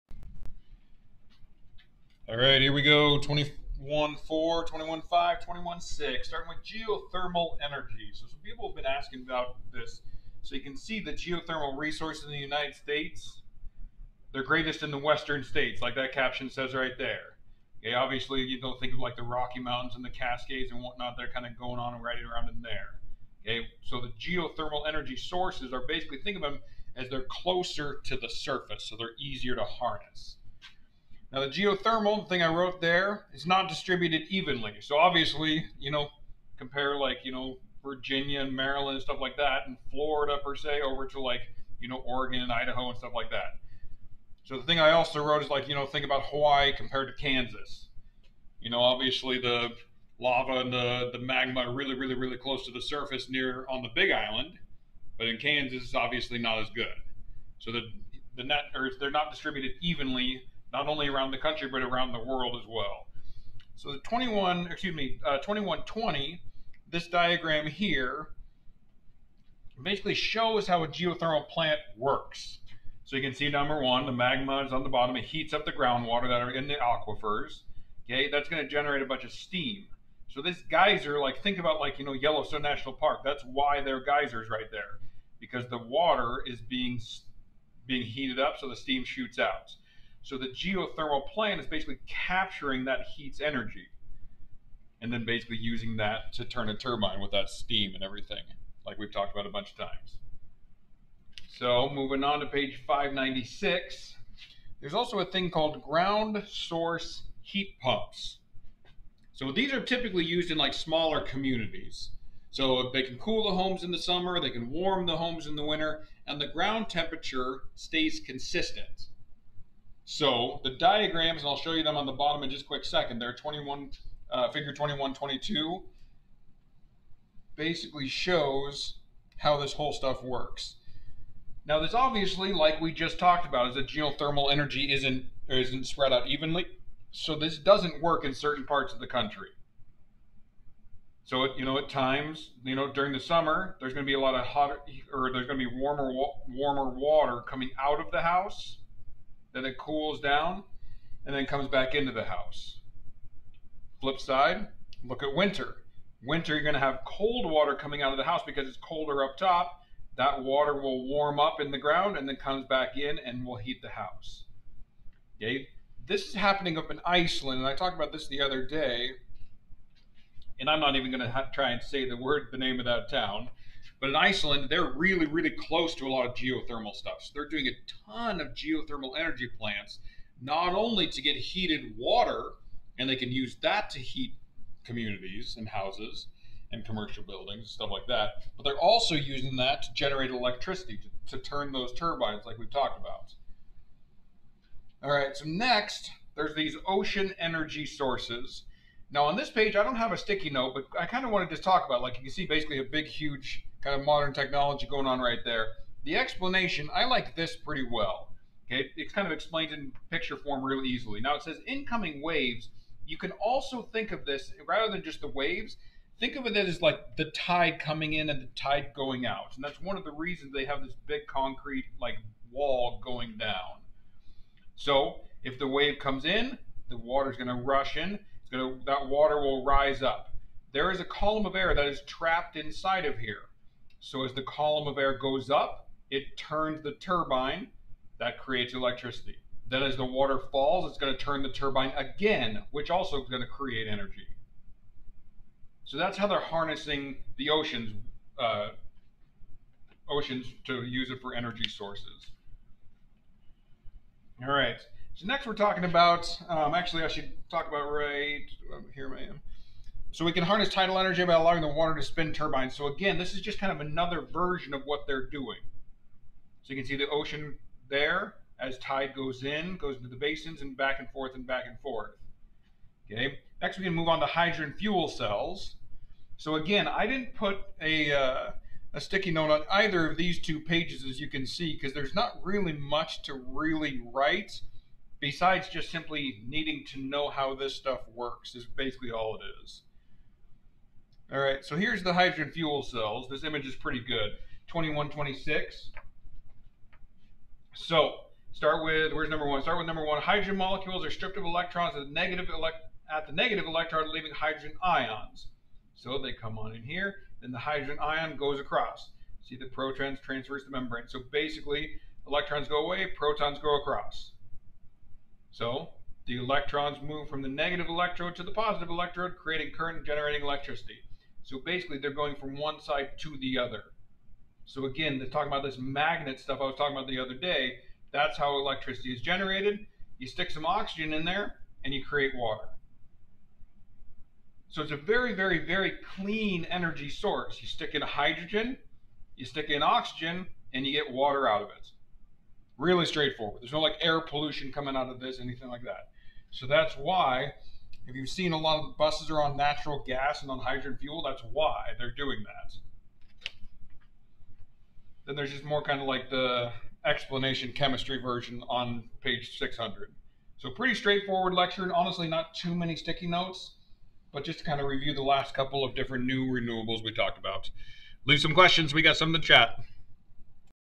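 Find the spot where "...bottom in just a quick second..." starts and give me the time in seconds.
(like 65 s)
122 s.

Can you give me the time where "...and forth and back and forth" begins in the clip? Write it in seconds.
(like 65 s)
270 s.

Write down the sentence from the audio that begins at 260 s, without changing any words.
So we can harness tidal energy by allowing the water to spin turbines.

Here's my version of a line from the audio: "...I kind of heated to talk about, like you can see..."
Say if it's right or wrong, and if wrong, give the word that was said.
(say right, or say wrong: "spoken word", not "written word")
wrong: "wanted", not "heated".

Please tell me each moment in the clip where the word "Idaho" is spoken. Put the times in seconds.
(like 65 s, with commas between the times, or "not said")
42 s.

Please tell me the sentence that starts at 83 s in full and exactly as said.
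That's why there are geysers right there because the water is being being heated up so the steam shoots out.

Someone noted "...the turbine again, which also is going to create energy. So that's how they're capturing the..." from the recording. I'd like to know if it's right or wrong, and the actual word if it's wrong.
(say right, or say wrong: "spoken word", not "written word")
wrong: "harnessing", not "capturing".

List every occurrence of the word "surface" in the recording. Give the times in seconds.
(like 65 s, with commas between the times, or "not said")
28 s, 52 s.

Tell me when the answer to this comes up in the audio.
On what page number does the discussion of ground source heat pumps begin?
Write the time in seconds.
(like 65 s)
102 s.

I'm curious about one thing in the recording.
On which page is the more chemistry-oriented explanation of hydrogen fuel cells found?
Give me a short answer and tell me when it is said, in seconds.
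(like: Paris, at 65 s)
600, at 359 s.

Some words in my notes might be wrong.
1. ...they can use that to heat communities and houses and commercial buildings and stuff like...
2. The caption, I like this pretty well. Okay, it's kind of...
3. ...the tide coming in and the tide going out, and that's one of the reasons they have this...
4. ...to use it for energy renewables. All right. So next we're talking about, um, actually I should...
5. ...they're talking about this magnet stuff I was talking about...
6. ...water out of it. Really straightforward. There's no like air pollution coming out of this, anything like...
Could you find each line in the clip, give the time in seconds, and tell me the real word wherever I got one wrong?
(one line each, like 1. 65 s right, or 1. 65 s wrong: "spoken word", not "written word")
1. 183 s right
2. 206 s wrong: "explanation", not "caption"
3. 217 s right
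4. 250 s wrong: "sources", not "renewables"
5. 325 s right
6. 341 s right.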